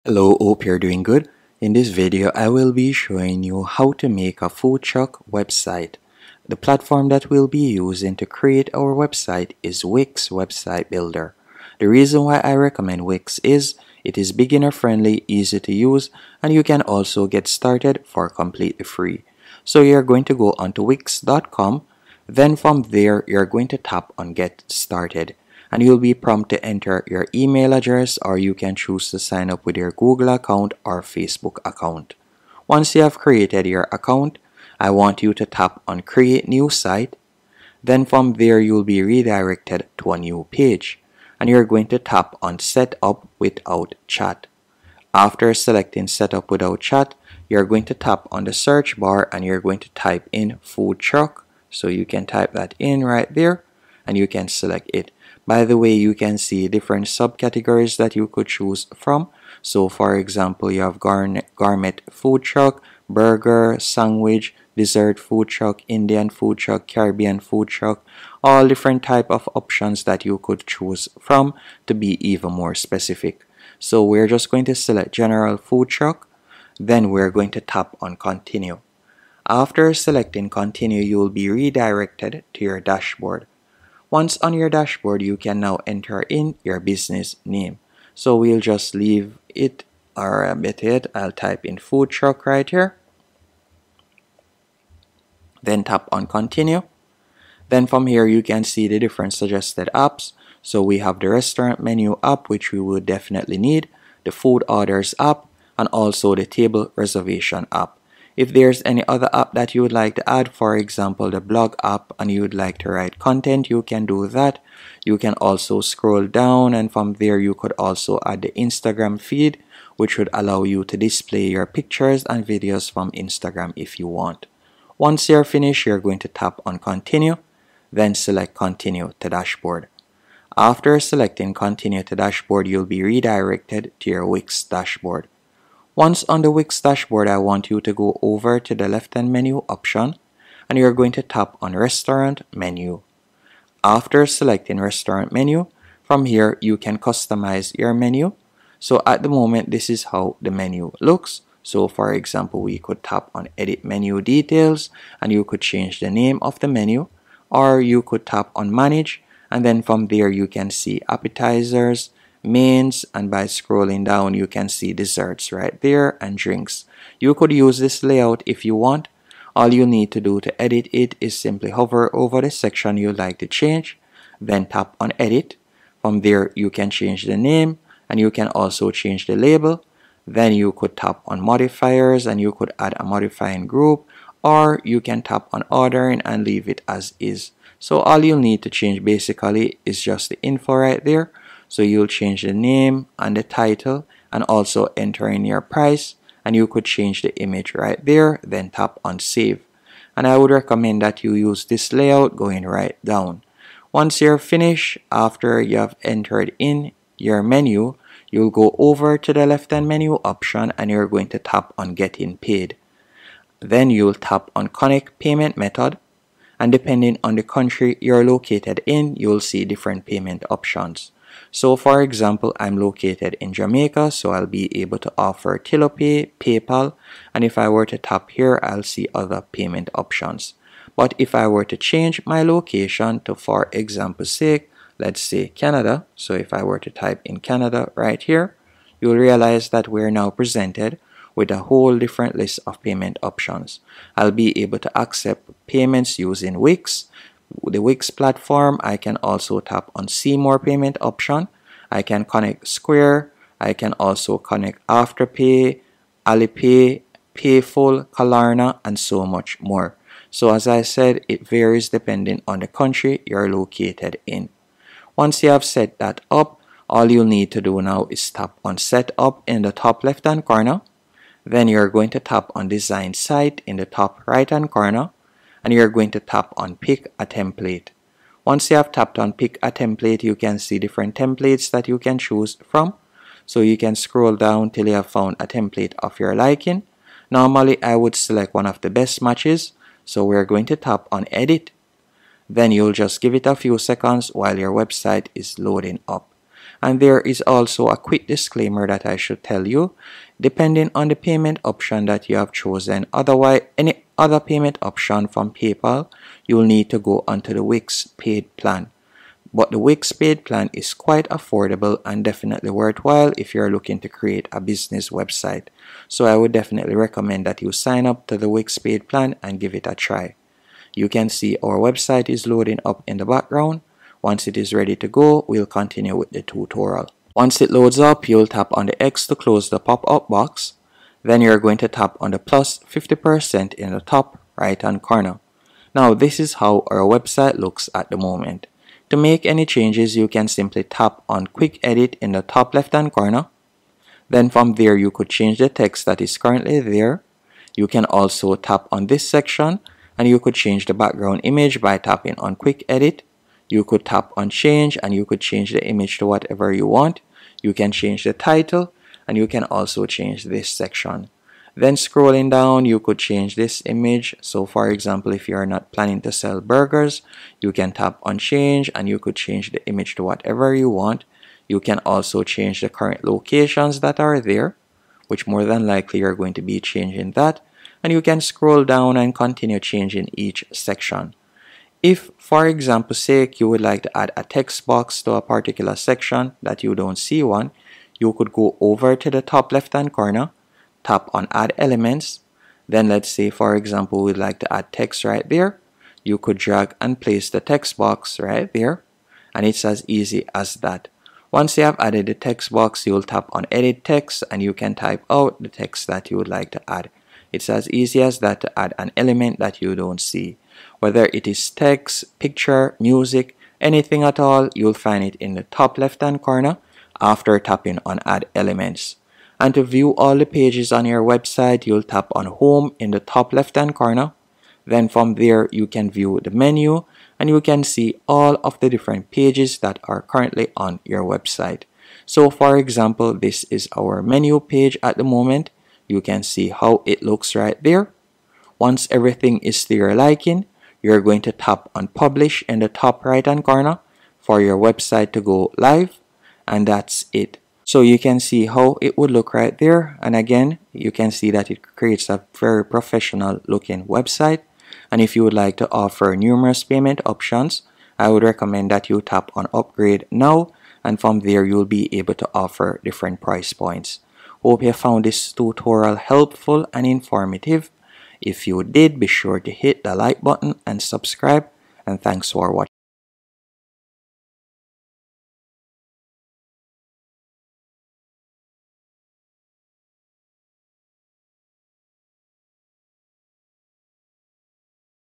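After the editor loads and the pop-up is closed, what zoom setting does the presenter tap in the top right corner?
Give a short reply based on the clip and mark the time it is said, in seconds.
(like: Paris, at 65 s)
Plus 50%, at 332 s.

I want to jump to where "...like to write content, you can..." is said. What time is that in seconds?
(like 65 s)
112 s.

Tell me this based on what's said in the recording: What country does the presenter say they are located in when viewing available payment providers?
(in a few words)
Jamaica.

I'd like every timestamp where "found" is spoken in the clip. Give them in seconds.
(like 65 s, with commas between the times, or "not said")
285 s, 464 s.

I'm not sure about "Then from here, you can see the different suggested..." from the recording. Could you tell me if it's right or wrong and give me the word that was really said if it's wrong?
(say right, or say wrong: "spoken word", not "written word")
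right.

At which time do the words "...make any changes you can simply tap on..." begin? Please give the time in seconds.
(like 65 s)
339 s.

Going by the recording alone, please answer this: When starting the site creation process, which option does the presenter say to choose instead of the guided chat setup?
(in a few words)
Set up without chat.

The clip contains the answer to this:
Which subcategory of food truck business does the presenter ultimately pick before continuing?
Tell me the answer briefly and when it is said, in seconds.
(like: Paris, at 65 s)
General food truck, at 75 s.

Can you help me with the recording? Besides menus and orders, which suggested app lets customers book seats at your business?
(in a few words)
Table reservation app.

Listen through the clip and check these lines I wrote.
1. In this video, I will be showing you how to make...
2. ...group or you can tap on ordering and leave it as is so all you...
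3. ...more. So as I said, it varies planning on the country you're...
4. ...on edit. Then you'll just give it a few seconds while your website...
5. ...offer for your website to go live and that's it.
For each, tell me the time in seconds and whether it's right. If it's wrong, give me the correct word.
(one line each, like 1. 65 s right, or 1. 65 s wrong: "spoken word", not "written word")
1. 1 s right
2. 183 s right
3. 259 s wrong: "depending", not "planning"
4. 291 s right
5. 443 s wrong: "corner", not "offer".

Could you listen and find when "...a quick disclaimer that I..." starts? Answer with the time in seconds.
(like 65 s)
297 s.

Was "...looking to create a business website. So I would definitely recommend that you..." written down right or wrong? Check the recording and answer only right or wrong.
right.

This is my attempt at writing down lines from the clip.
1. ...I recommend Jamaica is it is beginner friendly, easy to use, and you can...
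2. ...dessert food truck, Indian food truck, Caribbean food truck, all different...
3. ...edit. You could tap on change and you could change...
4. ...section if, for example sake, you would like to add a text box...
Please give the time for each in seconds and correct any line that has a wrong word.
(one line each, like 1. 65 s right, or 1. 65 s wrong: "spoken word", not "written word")
1. 12 s wrong: "Wix", not "Jamaica"
2. 64 s right
3. 352 s right
4. 380 s right.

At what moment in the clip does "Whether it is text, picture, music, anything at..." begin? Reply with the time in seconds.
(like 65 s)
410 s.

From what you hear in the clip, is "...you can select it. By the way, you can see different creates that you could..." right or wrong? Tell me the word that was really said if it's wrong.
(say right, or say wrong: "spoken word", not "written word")
wrong: "subcategories", not "creates".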